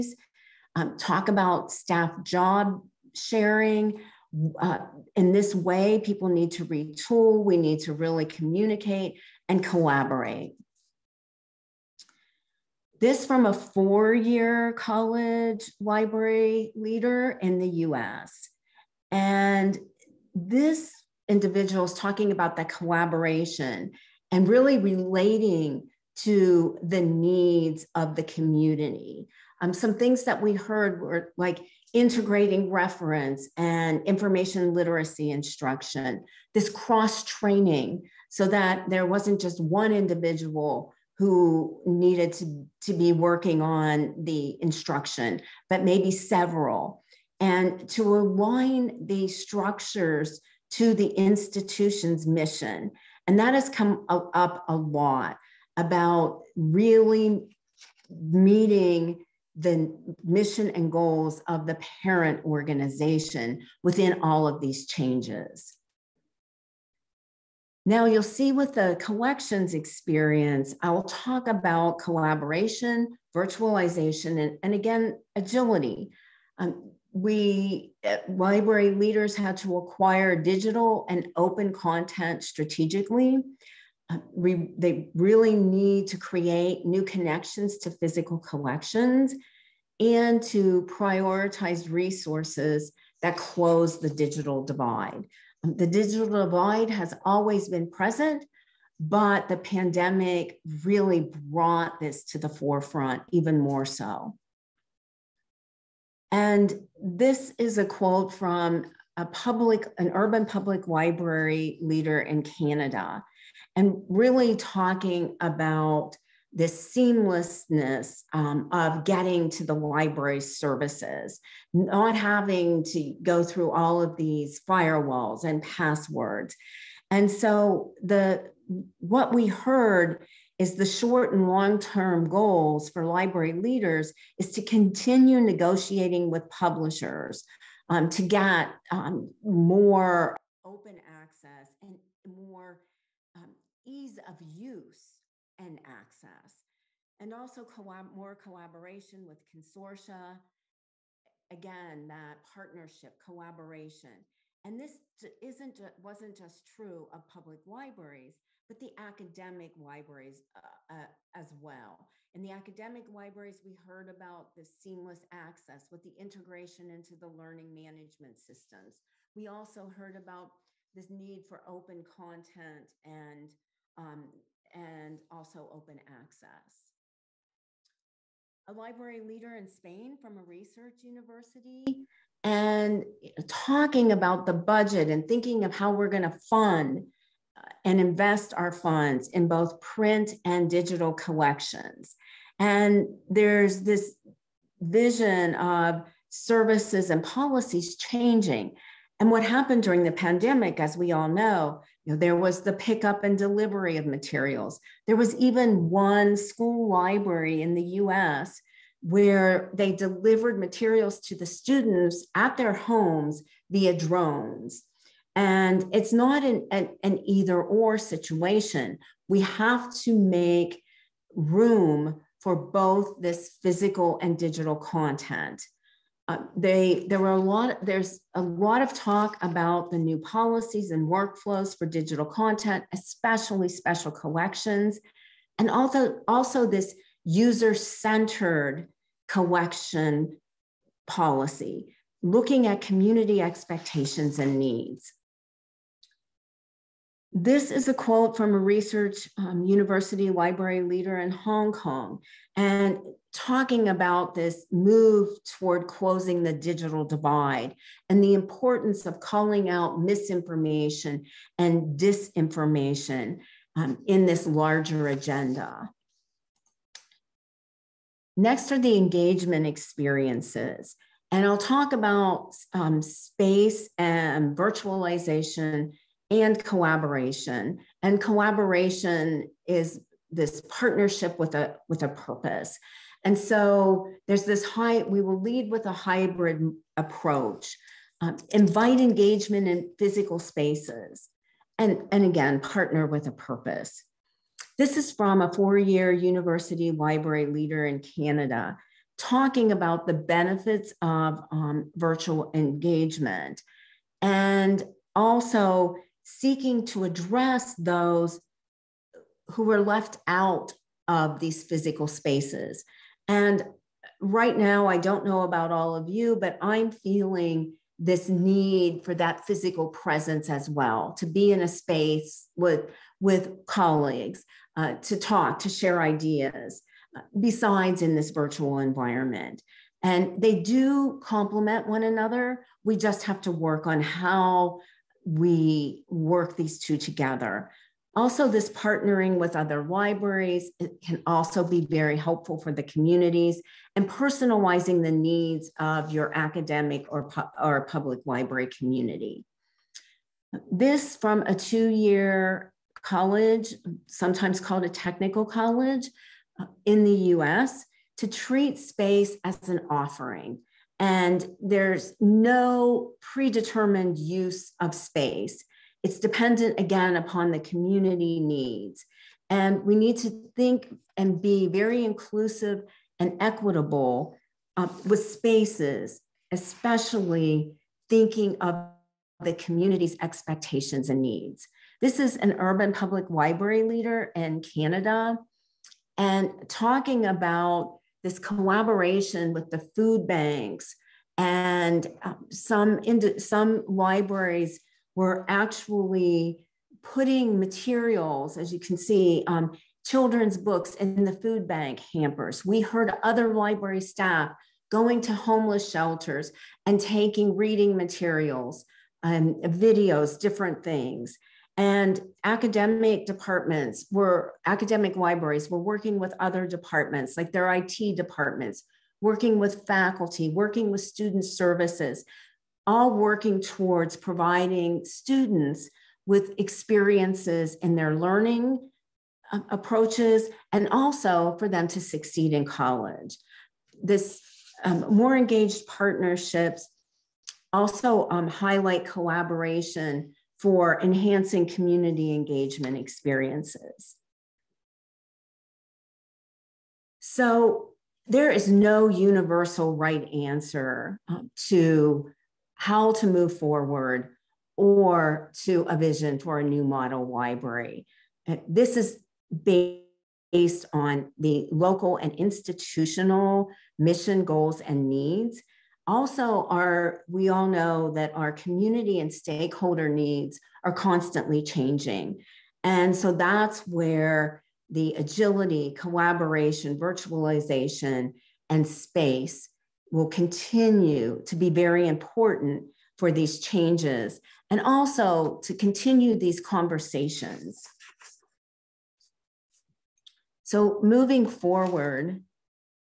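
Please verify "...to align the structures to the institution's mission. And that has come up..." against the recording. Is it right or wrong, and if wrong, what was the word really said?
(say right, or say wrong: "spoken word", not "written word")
right.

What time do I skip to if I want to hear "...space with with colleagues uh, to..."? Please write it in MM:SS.
05:21.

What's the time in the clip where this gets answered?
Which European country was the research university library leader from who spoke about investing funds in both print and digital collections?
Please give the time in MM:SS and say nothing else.
02:59.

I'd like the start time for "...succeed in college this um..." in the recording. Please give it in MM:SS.
07:12.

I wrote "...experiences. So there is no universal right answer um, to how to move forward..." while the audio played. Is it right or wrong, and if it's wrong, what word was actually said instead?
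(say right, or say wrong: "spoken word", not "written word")
right.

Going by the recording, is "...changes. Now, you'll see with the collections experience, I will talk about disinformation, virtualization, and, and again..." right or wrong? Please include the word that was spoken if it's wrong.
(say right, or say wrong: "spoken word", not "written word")
wrong: "collaboration", not "disinformation".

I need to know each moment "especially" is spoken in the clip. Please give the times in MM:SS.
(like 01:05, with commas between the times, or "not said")
03:52, 06:16.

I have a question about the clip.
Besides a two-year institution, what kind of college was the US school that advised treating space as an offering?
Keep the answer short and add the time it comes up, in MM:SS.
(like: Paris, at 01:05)
technical college, at 05:54.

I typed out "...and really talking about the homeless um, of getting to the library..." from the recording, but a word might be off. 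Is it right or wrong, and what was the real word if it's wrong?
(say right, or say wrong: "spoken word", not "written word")
wrong: "seamlessness", not "homeless".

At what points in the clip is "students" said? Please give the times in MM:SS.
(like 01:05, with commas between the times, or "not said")
03:31, 07:01, 07:05.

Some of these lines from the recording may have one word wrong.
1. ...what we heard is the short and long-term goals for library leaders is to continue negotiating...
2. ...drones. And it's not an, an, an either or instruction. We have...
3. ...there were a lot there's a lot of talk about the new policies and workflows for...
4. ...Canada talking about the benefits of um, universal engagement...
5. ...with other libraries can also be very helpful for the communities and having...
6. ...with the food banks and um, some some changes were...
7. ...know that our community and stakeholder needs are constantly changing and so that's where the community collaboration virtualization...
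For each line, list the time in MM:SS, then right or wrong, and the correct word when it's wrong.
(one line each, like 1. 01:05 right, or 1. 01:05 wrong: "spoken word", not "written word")
1. 02:08 right
2. 03:33 wrong: "situation", not "instruction"
3. 03:47 right
4. 04:58 wrong: "virtual", not "universal"
5. 05:39 wrong: "personalizing", not "having"
6. 06:29 wrong: "libraries", not "changes"
7. 07:47 wrong: "agility", not "community".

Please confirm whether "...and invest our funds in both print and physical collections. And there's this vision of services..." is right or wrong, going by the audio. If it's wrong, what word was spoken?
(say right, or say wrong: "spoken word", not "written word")
wrong: "digital", not "physical".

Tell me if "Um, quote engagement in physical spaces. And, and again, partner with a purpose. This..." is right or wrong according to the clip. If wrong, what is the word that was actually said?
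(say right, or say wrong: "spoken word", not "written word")
wrong: "invite", not "quote".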